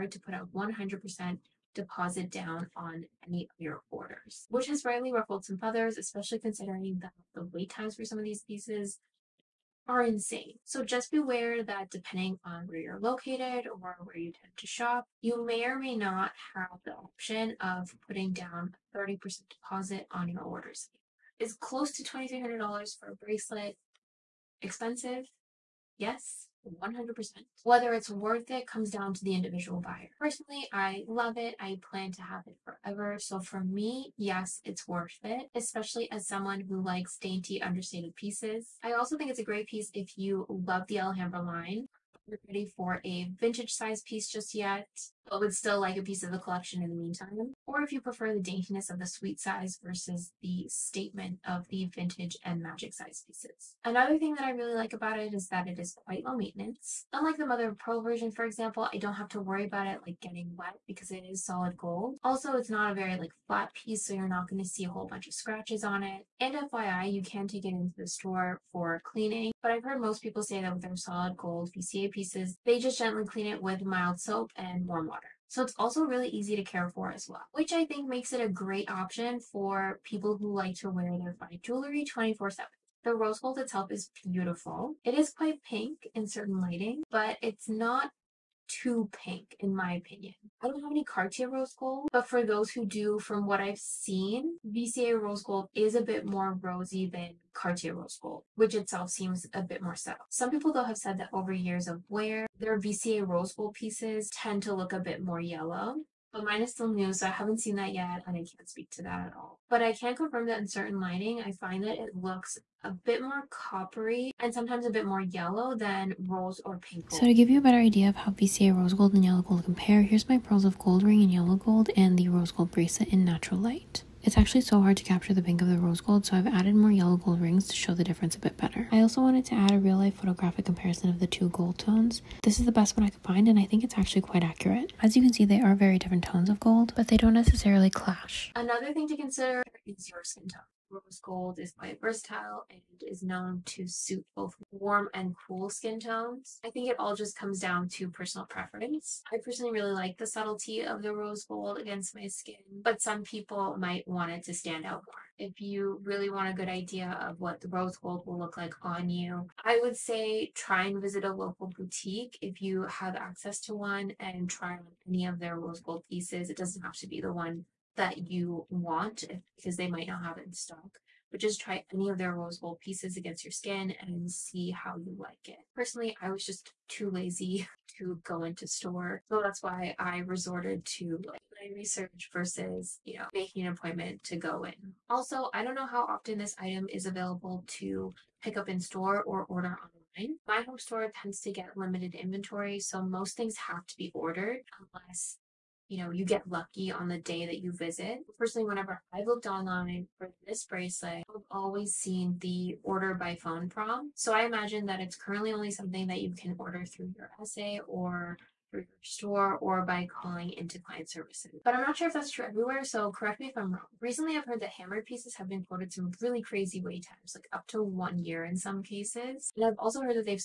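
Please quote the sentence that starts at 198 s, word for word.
Personally, whenever I've looked online for this bracelet, I've always seen the order by phone prompt.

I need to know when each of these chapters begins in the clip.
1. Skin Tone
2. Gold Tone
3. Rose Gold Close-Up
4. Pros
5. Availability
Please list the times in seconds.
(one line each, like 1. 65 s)
1. 137 s
2. 81 s
3. 115 s
4. 37 s
5. 183 s.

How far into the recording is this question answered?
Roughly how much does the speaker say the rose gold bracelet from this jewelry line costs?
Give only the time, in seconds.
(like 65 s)
22 s.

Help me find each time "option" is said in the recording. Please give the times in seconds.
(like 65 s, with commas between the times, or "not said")
16 s, 78 s.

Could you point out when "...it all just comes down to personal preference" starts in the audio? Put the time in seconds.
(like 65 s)
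146 s.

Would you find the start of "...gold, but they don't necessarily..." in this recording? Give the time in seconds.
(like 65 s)
136 s.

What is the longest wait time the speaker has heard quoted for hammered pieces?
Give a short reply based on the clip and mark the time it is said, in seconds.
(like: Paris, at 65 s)
1 year, at 217 s.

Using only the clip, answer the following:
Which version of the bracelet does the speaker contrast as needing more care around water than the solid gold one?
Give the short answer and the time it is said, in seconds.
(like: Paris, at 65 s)
Mother of Pearl, at 57 s.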